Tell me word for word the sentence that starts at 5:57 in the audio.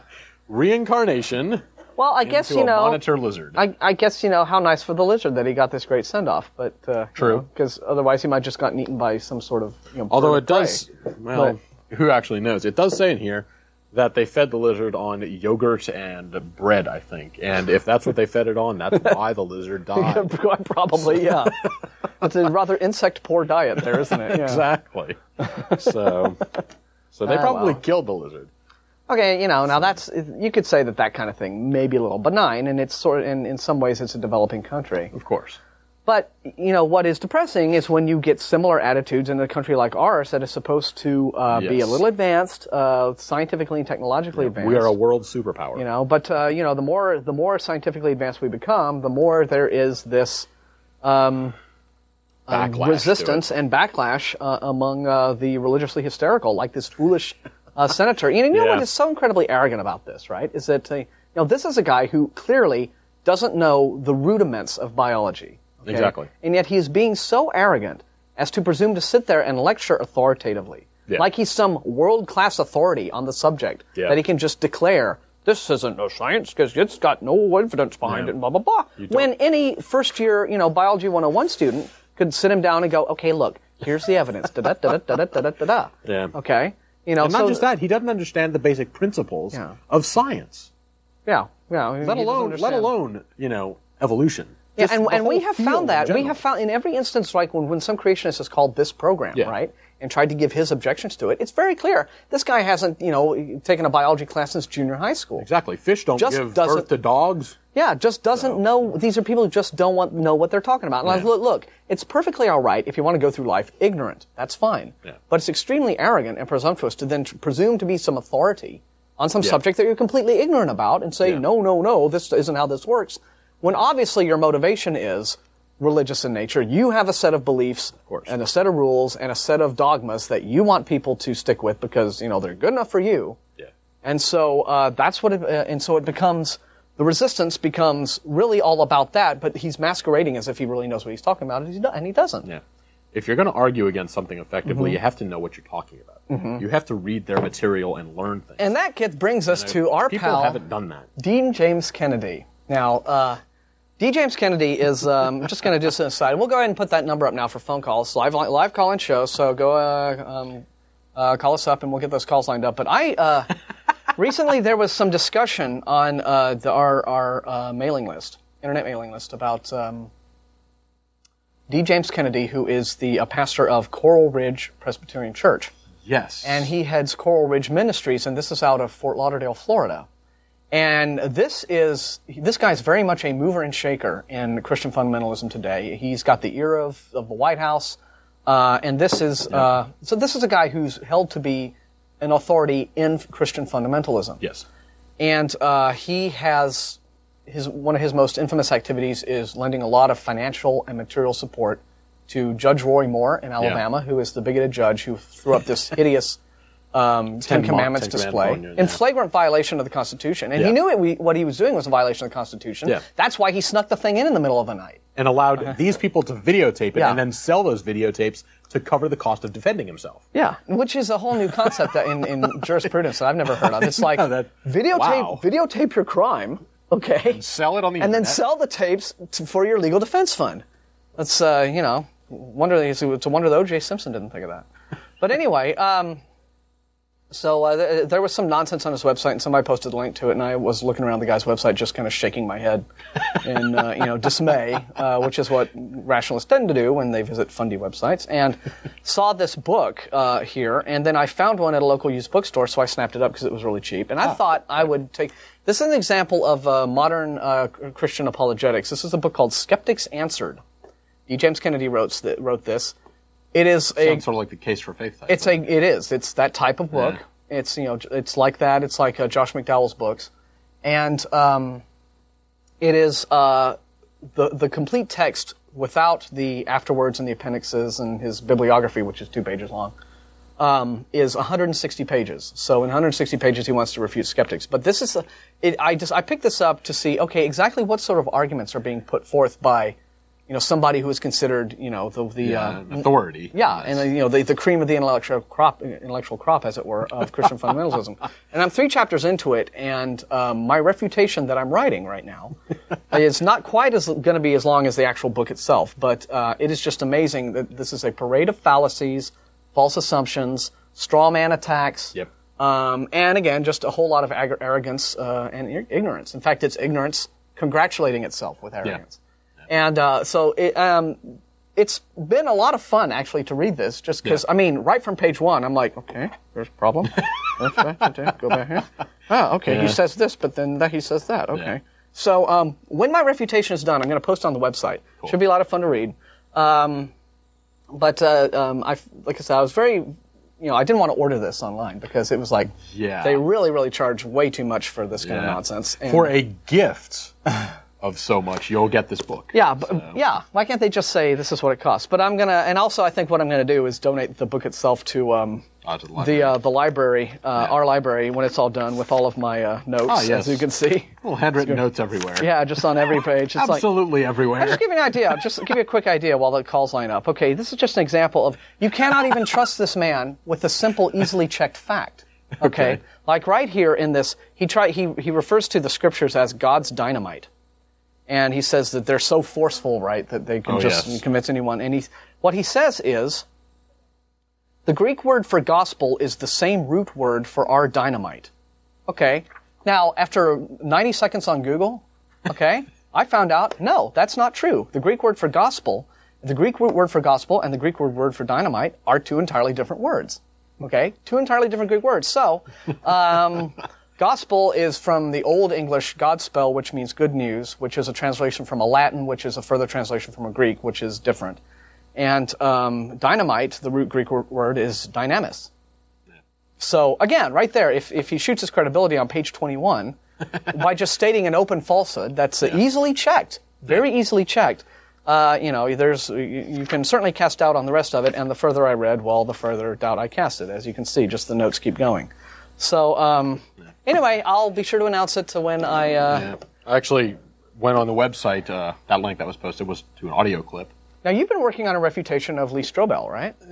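our library, when it's all done with all of my uh, notes, ah, yes.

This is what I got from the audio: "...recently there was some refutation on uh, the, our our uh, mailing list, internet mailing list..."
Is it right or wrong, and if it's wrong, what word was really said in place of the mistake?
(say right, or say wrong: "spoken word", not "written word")
wrong: "discussion", not "refutation".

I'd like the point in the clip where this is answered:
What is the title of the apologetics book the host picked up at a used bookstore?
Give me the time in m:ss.
4:19.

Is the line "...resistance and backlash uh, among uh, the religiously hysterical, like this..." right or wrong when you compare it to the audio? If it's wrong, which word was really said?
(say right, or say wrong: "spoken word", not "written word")
right.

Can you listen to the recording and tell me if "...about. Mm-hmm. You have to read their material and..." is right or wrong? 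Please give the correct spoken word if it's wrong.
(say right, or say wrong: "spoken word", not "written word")
right.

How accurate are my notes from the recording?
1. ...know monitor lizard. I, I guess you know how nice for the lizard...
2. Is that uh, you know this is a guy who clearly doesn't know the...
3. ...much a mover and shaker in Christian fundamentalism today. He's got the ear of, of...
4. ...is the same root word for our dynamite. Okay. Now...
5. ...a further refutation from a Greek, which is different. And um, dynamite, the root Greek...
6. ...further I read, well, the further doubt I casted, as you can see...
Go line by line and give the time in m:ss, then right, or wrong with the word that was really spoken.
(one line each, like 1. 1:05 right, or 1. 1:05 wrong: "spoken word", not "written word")
1. 0:02 right
2. 1:00 right
3. 3:03 right
4. 6:26 right
5. 6:49 wrong: "translation", not "refutation"
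6. 7:08 right.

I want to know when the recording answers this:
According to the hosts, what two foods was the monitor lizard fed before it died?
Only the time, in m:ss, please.
0:15.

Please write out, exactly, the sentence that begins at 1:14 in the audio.
that he can just declare this isn't no science because it's got no evidence behind yeah.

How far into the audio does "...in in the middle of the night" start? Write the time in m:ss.
3:34.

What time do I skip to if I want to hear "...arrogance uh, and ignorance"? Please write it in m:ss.
5:14.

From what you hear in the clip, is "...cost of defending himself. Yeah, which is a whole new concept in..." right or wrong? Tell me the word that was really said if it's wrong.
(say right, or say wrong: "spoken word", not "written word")
right.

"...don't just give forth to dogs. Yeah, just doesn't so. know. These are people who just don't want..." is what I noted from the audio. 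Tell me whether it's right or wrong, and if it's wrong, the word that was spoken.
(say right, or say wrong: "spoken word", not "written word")
wrong: "birth", not "forth".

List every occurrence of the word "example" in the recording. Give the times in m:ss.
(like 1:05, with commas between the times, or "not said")
4:15, 6:08.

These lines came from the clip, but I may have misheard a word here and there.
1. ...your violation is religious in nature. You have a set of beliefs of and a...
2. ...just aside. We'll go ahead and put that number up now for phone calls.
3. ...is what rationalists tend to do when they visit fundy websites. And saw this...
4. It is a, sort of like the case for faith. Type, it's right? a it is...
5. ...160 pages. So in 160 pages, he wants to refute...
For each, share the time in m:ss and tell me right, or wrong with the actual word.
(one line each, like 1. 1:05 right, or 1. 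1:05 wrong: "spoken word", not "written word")
1. 2:04 wrong: "motivation", not "violation"
2. 2:35 right
3. 4:05 right
4. 4:23 right
5. 4:41 right.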